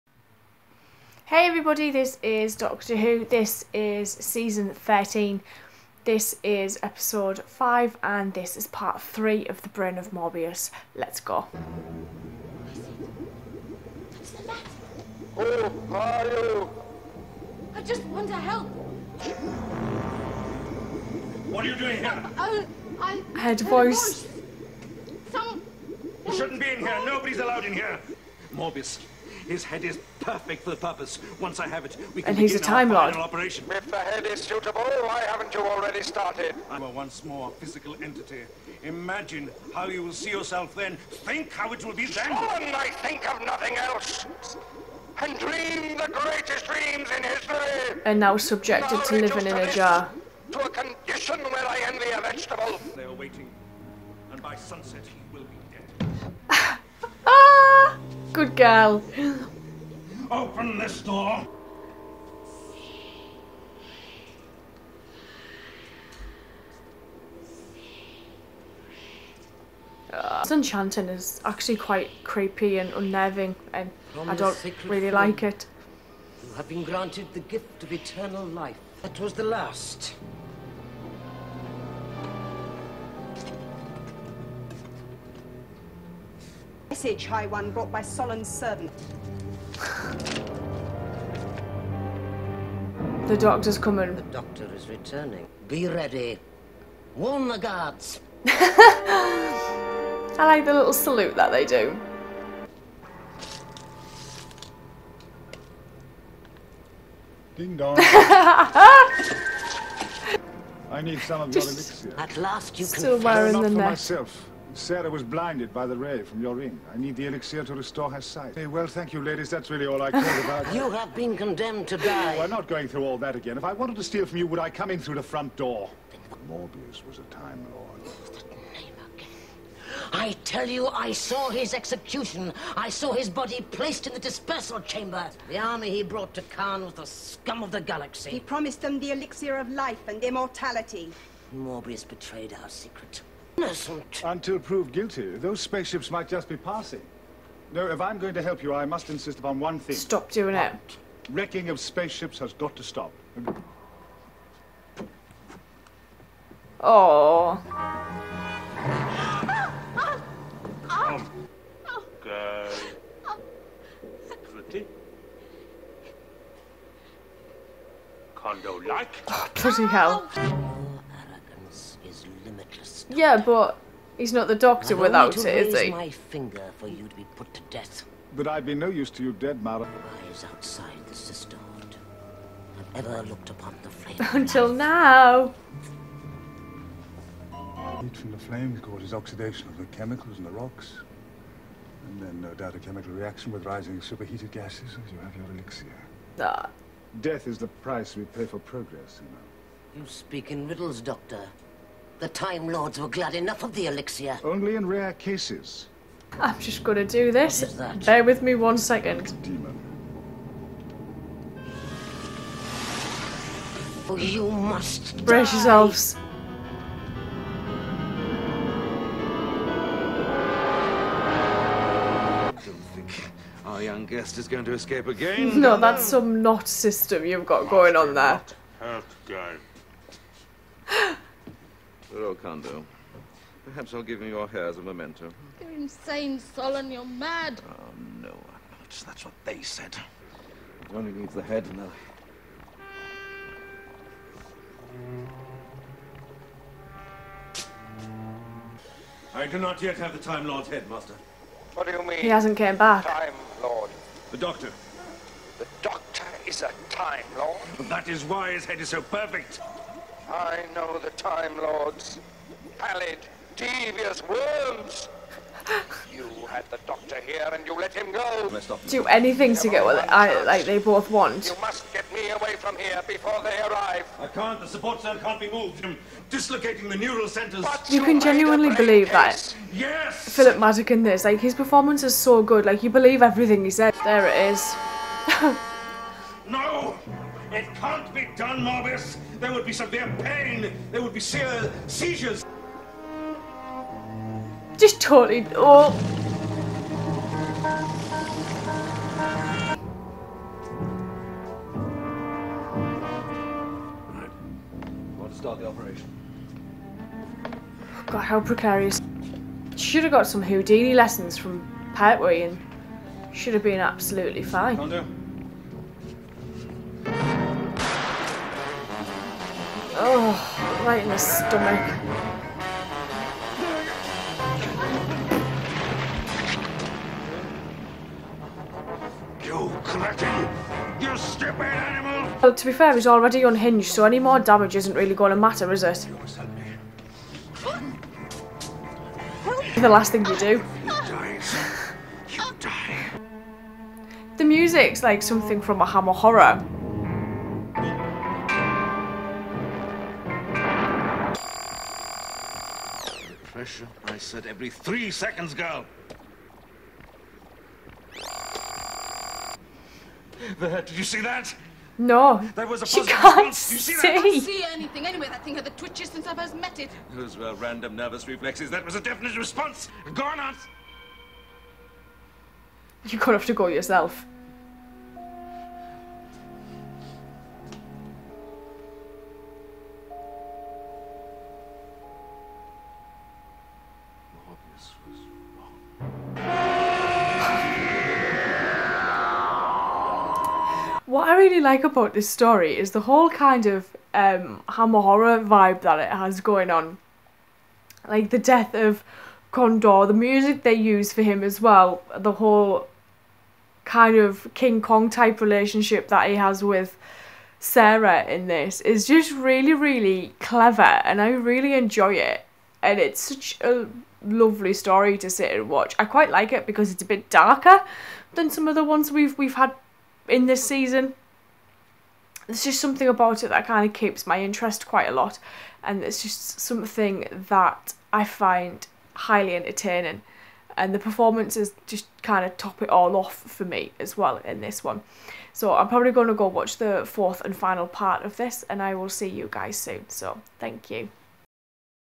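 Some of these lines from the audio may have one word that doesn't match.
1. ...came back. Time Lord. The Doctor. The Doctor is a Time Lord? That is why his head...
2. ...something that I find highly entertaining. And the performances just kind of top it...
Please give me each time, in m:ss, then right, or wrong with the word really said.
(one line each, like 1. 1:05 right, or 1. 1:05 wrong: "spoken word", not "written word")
1. 4:12 right
2. 7:06 right.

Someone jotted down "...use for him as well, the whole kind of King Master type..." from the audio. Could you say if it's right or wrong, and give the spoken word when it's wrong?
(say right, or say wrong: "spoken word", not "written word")
wrong: "Kong", not "Master".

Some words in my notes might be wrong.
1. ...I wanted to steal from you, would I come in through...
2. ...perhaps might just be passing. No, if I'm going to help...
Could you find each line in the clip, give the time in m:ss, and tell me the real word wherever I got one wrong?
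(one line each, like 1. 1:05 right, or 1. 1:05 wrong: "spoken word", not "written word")
1. 2:03 right
2. 2:25 wrong: "spaceships", not "perhaps".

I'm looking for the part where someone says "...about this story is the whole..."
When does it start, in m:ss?
6:31.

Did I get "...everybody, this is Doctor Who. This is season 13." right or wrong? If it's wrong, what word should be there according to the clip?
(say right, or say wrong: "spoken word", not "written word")
right.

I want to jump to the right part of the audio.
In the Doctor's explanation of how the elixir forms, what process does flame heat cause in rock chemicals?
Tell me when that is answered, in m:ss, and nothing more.
3:09.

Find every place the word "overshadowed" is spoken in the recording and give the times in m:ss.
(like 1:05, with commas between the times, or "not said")
not said.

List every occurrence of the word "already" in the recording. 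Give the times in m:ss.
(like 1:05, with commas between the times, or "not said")
0:35, 5:33.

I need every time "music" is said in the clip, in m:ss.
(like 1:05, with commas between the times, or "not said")
5:44, 6:40.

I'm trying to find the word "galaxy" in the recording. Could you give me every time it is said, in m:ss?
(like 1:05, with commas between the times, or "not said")
2:17.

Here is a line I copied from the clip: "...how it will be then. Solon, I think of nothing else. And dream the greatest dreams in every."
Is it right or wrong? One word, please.
wrong.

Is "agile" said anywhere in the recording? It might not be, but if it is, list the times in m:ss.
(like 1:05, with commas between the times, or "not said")
not said.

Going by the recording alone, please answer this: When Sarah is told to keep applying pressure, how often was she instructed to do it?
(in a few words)
every 3 seconds.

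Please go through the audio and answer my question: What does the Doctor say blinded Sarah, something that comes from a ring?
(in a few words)
the ray.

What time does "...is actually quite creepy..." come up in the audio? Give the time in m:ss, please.
1:11.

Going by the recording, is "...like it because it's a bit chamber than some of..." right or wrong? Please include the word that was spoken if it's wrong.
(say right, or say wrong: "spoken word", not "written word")
wrong: "darker", not "chamber".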